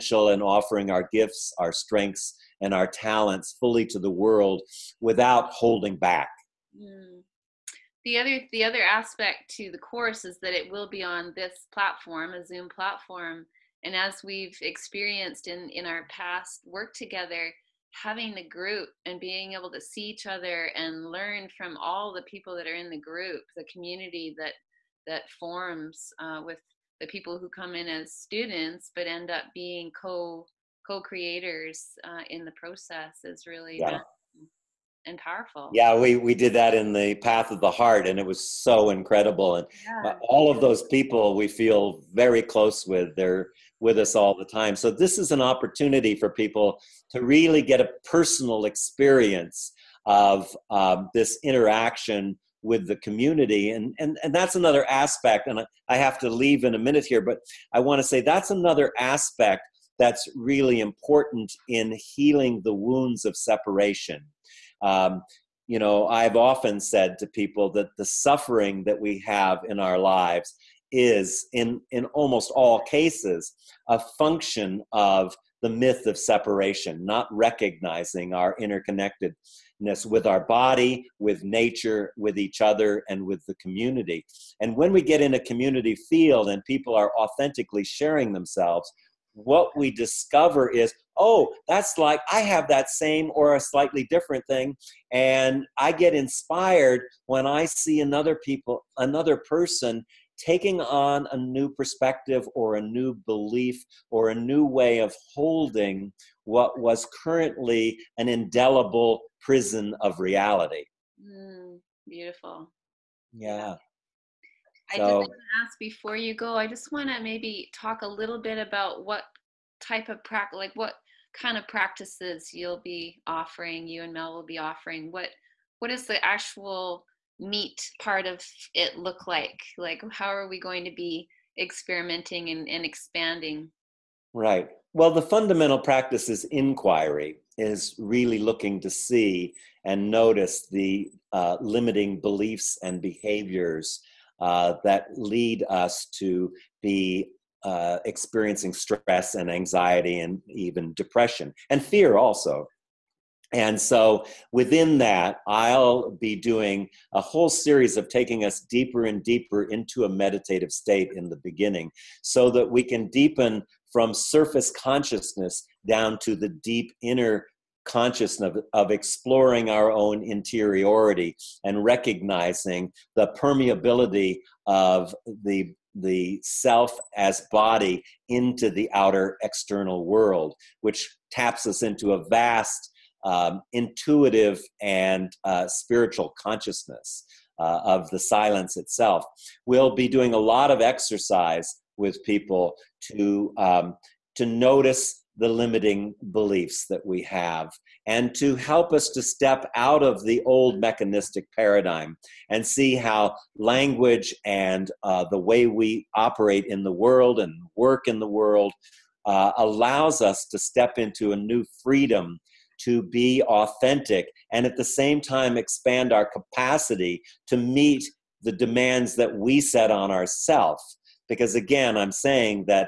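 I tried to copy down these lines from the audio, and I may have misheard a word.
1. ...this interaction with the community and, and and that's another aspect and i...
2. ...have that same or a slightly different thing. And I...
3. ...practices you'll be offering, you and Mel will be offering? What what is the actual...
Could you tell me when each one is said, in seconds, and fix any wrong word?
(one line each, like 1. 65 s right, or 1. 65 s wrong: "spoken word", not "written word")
1. 51 s right
2. 92 s right
3. 121 s right.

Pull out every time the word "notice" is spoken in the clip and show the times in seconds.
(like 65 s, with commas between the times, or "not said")
140 s, 194 s.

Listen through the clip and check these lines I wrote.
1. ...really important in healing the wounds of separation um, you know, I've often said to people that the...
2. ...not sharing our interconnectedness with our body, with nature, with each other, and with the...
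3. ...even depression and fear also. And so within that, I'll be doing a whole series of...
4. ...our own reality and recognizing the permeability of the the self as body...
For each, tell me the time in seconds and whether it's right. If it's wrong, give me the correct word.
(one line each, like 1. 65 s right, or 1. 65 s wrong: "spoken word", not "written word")
1. 60 s right
2. 77 s wrong: "recognizing", not "sharing"
3. 150 s right
4. 169 s wrong: "interiority", not "reality".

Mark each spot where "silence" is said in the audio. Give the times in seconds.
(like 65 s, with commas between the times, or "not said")
188 s.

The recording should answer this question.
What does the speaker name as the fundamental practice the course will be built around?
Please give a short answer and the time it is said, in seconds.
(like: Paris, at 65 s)
inquiry, at 136 s.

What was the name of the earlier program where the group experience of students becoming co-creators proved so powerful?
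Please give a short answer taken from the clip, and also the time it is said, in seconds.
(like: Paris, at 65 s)
Path of the Heart, at 37 s.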